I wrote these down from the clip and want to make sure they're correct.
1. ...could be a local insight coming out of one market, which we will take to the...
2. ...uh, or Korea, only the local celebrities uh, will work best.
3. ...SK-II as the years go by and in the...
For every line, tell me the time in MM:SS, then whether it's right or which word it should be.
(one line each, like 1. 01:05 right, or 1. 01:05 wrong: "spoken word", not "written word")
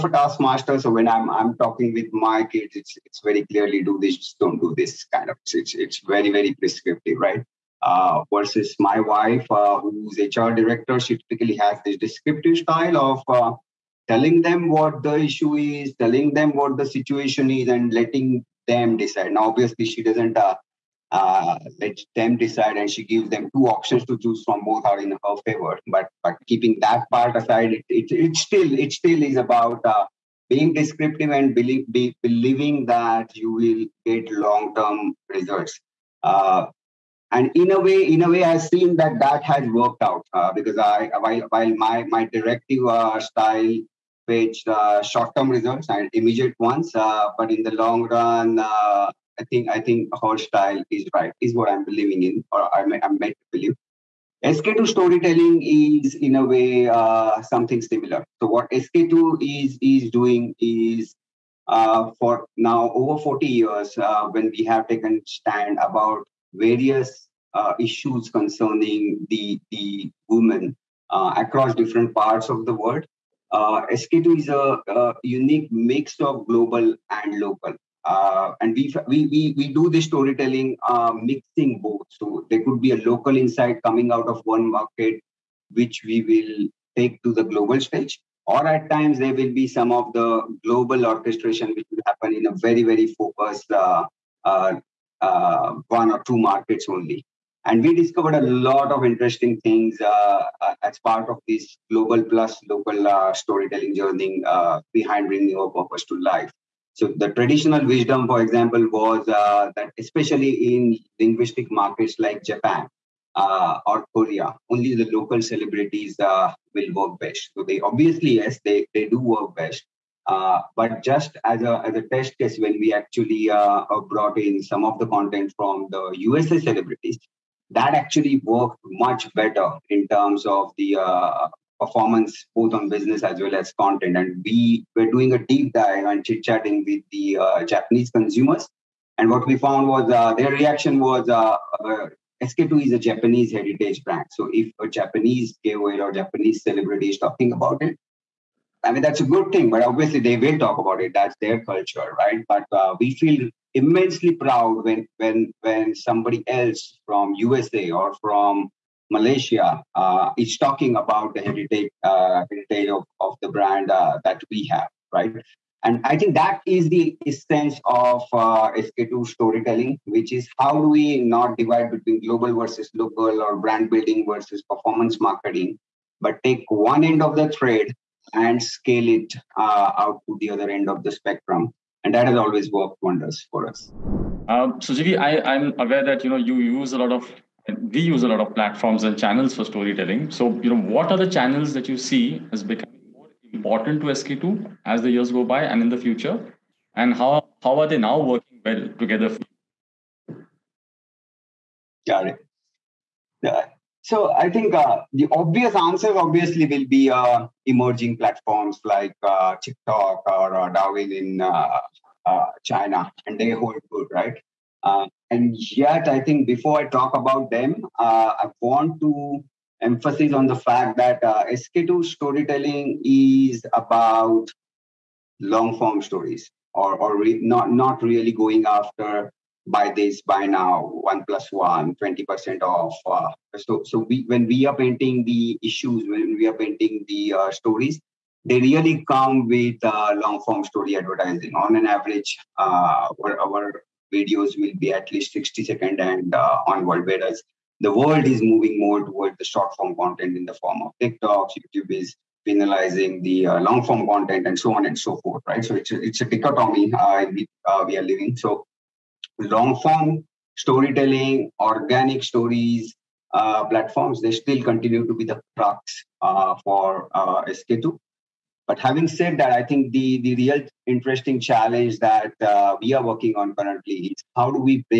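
1. 01:22 right
2. 01:53 right
3. 03:14 right.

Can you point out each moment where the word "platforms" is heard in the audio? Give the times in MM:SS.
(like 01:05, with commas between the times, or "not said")
03:08, 03:28, 04:23.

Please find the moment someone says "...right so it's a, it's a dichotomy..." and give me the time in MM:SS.
04:15.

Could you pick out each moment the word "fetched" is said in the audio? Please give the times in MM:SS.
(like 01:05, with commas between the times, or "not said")
00:44.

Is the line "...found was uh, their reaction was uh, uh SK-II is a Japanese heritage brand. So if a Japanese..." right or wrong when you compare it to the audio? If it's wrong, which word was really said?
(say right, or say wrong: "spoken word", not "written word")
right.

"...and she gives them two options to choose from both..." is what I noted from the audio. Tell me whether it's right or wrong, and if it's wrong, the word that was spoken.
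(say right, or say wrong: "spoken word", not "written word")
right.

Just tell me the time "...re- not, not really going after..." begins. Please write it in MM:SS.
03:47.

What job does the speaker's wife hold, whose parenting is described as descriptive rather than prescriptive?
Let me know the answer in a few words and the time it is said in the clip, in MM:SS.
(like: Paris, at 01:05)
HR director, at 00:10.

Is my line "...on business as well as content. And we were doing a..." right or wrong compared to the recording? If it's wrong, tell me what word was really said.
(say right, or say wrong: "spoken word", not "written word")
right.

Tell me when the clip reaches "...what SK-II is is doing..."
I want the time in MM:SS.
00:58.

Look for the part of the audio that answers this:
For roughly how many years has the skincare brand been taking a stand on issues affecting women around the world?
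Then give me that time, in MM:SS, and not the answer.
01:03.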